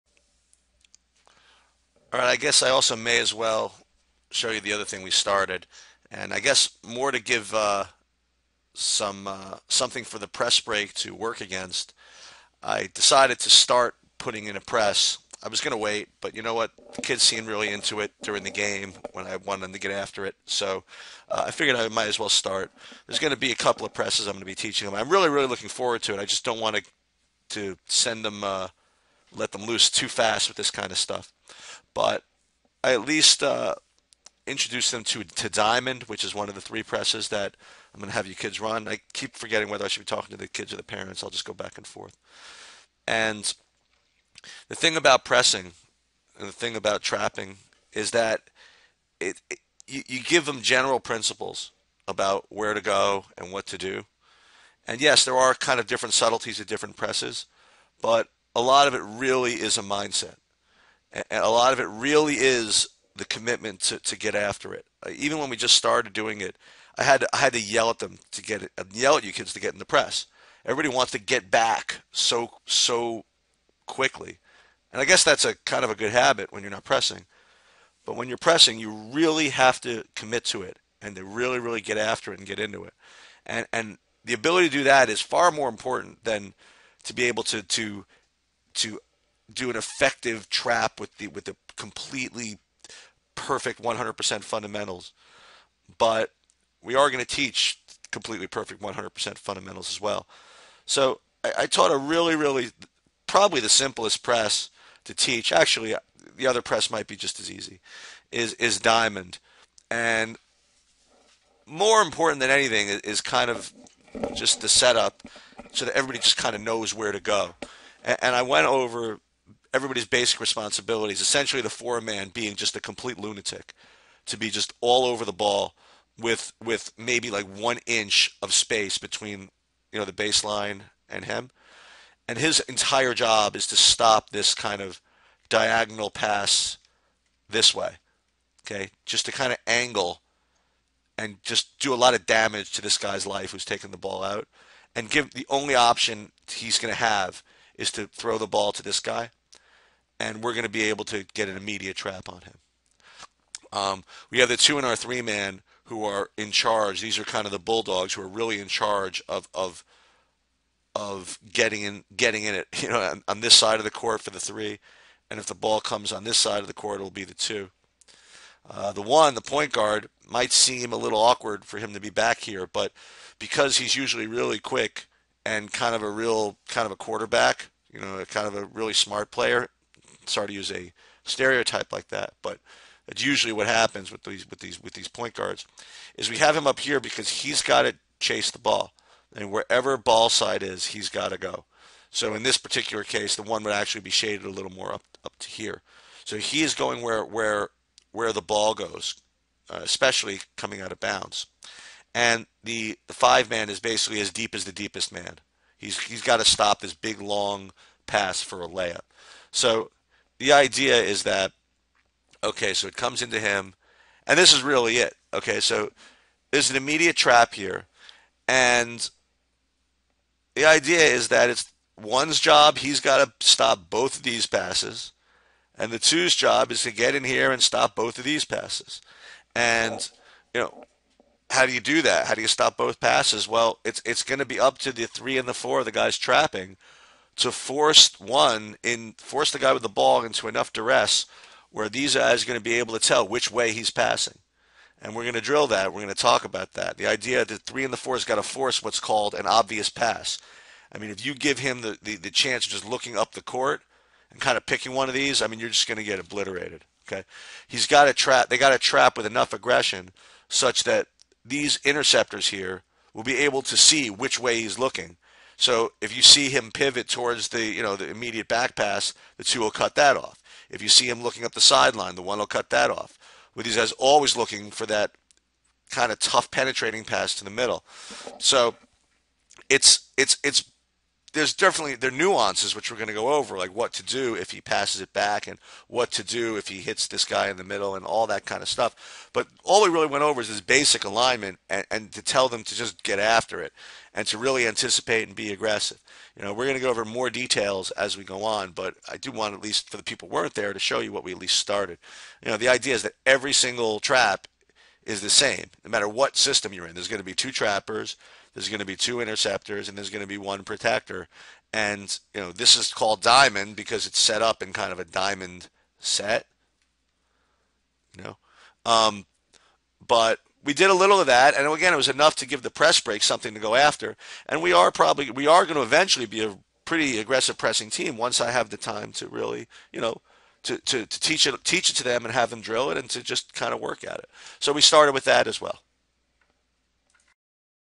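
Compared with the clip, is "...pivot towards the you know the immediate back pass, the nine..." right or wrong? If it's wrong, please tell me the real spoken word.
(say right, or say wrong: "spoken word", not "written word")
wrong: "two", not "nine".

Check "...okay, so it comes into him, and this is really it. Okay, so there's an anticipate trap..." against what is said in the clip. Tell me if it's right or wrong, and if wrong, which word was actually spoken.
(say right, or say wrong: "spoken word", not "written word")
wrong: "immediate", not "anticipate".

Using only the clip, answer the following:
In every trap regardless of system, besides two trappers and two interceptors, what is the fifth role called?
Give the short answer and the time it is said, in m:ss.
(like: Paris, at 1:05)
protector, at 5:10.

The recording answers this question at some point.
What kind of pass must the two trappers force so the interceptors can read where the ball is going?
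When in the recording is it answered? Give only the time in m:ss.
4:09.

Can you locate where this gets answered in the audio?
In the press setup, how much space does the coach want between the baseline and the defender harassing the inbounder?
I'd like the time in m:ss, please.
2:07.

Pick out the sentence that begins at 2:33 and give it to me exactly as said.
Um, we have the two in our three man who are in charge.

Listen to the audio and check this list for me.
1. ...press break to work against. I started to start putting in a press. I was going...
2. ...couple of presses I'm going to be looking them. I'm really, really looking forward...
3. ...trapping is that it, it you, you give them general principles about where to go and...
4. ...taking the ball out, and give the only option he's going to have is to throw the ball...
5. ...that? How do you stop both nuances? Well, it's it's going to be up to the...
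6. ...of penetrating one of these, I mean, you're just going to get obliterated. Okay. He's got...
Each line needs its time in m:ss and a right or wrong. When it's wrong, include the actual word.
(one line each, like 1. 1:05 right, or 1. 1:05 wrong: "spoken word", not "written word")
1. 0:10 wrong: "decided", not "started"
2. 0:23 wrong: "teaching", not "looking"
3. 0:47 right
4. 2:23 right
5. 3:52 wrong: "passes", not "nuances"
6. 4:14 wrong: "picking", not "penetrating".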